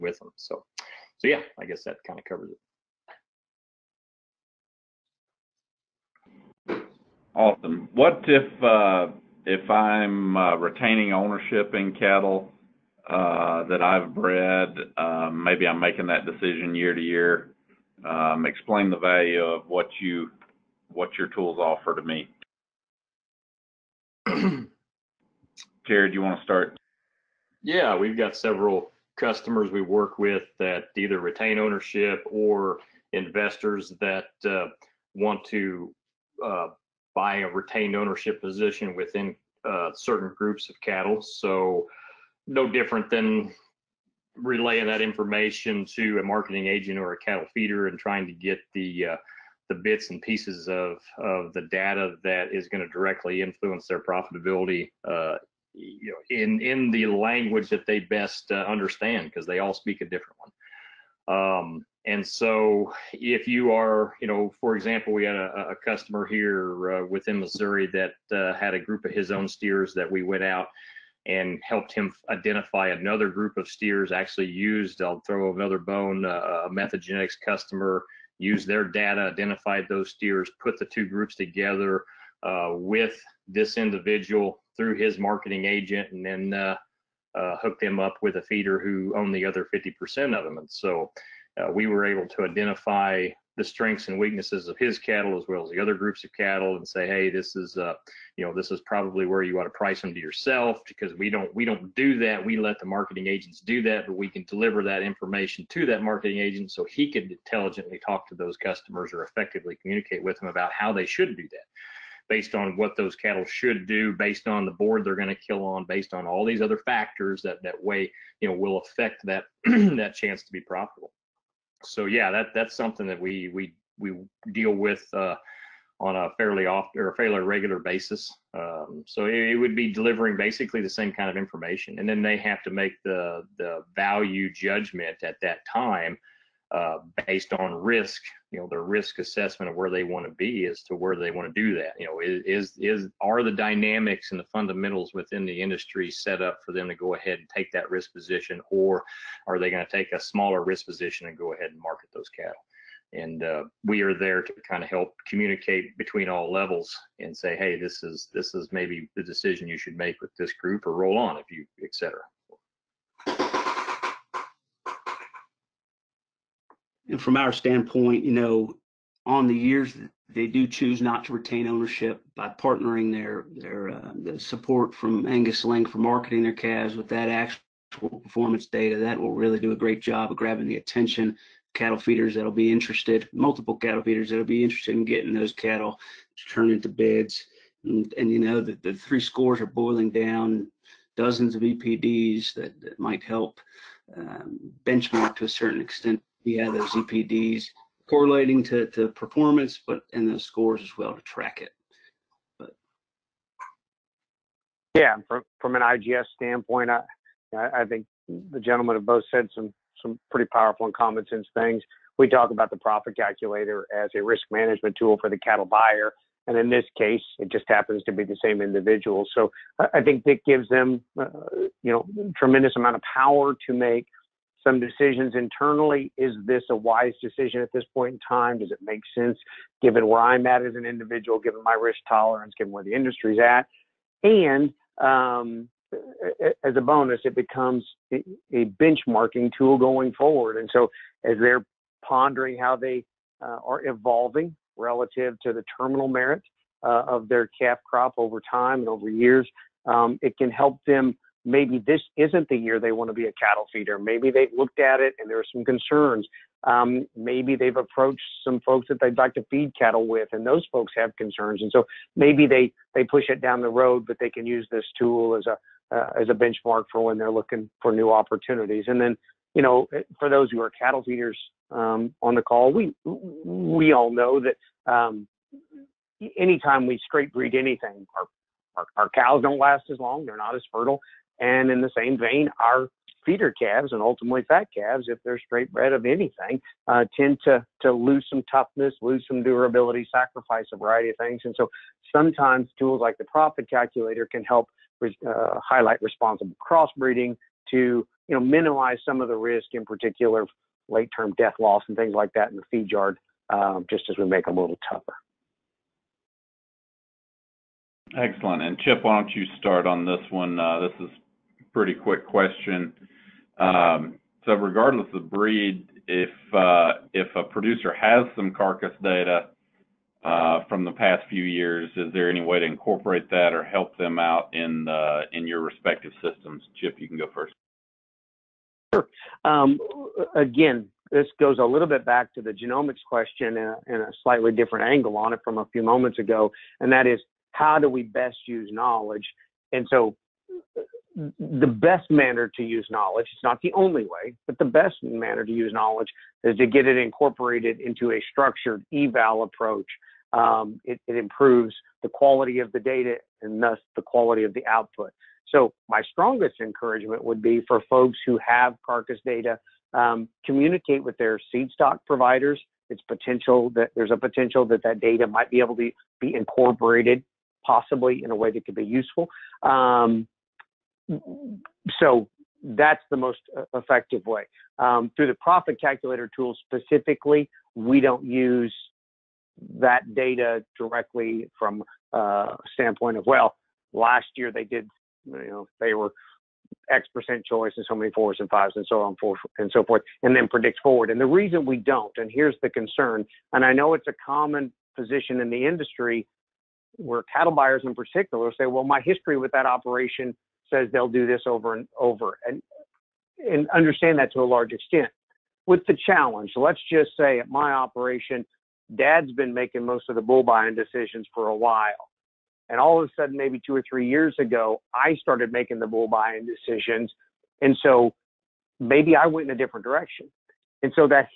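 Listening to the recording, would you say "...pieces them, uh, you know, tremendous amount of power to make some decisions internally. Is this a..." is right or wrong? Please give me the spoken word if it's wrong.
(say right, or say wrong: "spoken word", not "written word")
wrong: "gives", not "pieces".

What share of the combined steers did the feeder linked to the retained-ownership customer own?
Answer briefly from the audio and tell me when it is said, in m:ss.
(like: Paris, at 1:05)
50%, at 1:29.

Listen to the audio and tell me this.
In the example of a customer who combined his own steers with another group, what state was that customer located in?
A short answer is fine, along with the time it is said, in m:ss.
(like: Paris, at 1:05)
Missouri, at 1:07.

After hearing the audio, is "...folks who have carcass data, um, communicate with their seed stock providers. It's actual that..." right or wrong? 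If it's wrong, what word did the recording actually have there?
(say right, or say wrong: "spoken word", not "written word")
wrong: "potential", not "actual".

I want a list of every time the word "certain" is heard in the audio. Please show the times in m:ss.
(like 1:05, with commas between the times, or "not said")
0:39, 3:15.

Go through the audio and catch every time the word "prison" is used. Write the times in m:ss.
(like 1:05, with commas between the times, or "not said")
not said.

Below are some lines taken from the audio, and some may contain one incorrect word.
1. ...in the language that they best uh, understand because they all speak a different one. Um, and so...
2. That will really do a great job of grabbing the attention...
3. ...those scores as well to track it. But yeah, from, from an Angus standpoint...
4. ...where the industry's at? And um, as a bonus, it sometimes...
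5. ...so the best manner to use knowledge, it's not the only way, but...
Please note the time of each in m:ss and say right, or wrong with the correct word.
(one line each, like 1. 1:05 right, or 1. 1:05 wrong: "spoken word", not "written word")
1. 0:56 right
2. 2:58 right
3. 3:20 wrong: "IGS", not "Angus"
4. 3:52 wrong: "becomes", not "sometimes"
5. 5:39 right.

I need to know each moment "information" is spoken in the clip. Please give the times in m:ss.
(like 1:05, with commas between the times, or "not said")
0:45, 1:45, 2:11.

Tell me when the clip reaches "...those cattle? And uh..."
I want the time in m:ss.
2:32.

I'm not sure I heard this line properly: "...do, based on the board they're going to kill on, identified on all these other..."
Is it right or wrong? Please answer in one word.
wrong.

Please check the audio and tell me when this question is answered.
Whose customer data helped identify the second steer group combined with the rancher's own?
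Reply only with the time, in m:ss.
1:16.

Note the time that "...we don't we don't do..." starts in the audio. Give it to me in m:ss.
1:41.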